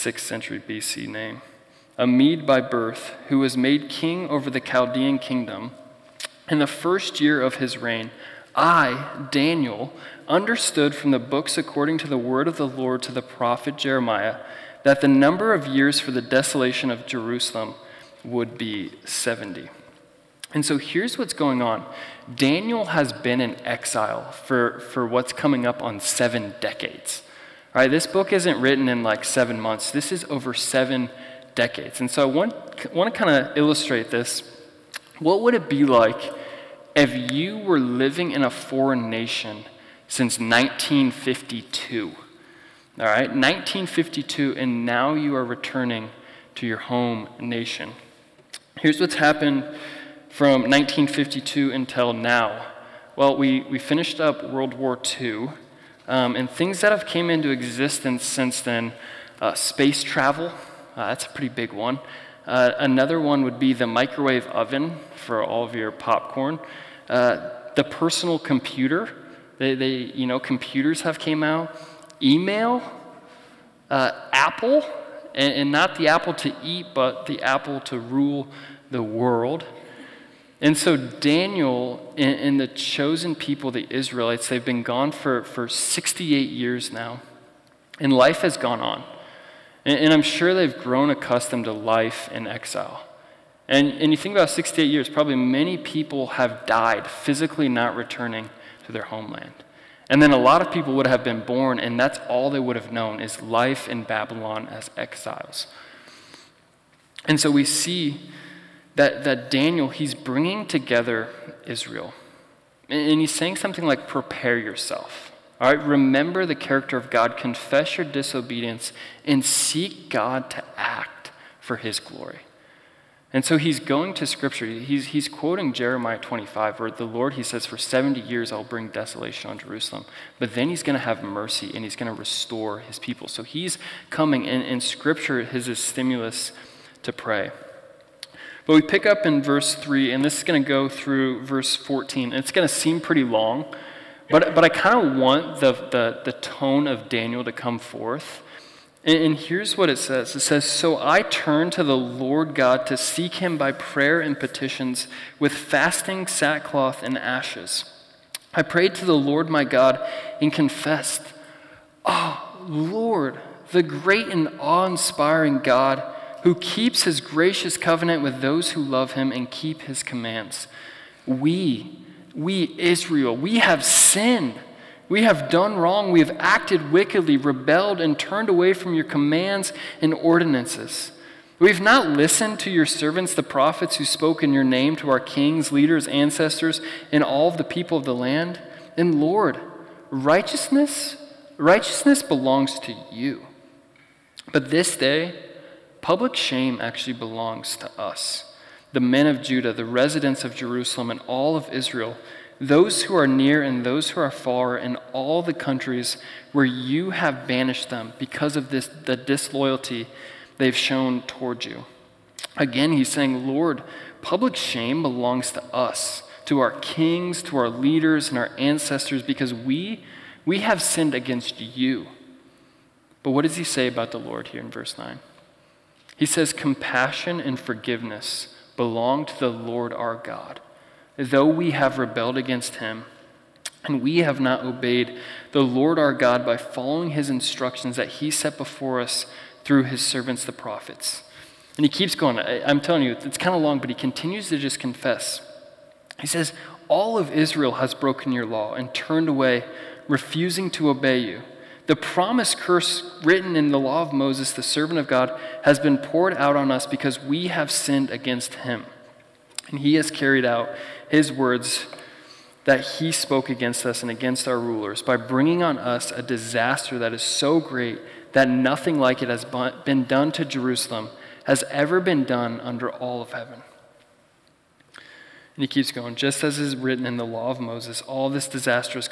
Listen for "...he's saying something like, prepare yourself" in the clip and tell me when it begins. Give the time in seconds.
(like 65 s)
113 s.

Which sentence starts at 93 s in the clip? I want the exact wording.
And, and you think about 68 years, probably many people have died physically not returning to their homeland.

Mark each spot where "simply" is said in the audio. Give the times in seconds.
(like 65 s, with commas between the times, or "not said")
not said.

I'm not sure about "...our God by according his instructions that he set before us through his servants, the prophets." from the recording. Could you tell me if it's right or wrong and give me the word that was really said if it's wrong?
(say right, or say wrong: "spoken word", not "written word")
wrong: "following", not "according".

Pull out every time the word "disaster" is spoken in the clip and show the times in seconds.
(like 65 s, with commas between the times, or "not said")
266 s, 278 s.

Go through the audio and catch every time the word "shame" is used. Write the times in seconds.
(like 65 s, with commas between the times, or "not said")
196 s, 214 s.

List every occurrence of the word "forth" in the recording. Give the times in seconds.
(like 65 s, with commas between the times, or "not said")
147 s.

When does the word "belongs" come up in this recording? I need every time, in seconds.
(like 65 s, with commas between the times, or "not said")
192 s, 197 s, 215 s, 228 s.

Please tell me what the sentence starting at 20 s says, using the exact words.
And so here's what's going on Daniel has been in exile for, for what's coming up on seven decades.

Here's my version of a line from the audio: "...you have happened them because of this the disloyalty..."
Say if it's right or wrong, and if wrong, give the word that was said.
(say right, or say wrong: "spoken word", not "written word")
wrong: "banished", not "happened".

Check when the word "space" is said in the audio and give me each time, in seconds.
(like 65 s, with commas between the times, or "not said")
59 s.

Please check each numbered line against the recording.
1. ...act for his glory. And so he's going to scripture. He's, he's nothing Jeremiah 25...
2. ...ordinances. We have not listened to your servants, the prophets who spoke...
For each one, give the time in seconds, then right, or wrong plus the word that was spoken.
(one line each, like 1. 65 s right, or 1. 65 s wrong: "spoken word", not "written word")
1. 120 s wrong: "quoting", not "nothing"
2. 180 s right.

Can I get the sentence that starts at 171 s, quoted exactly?
We, we Israel, we have sinned.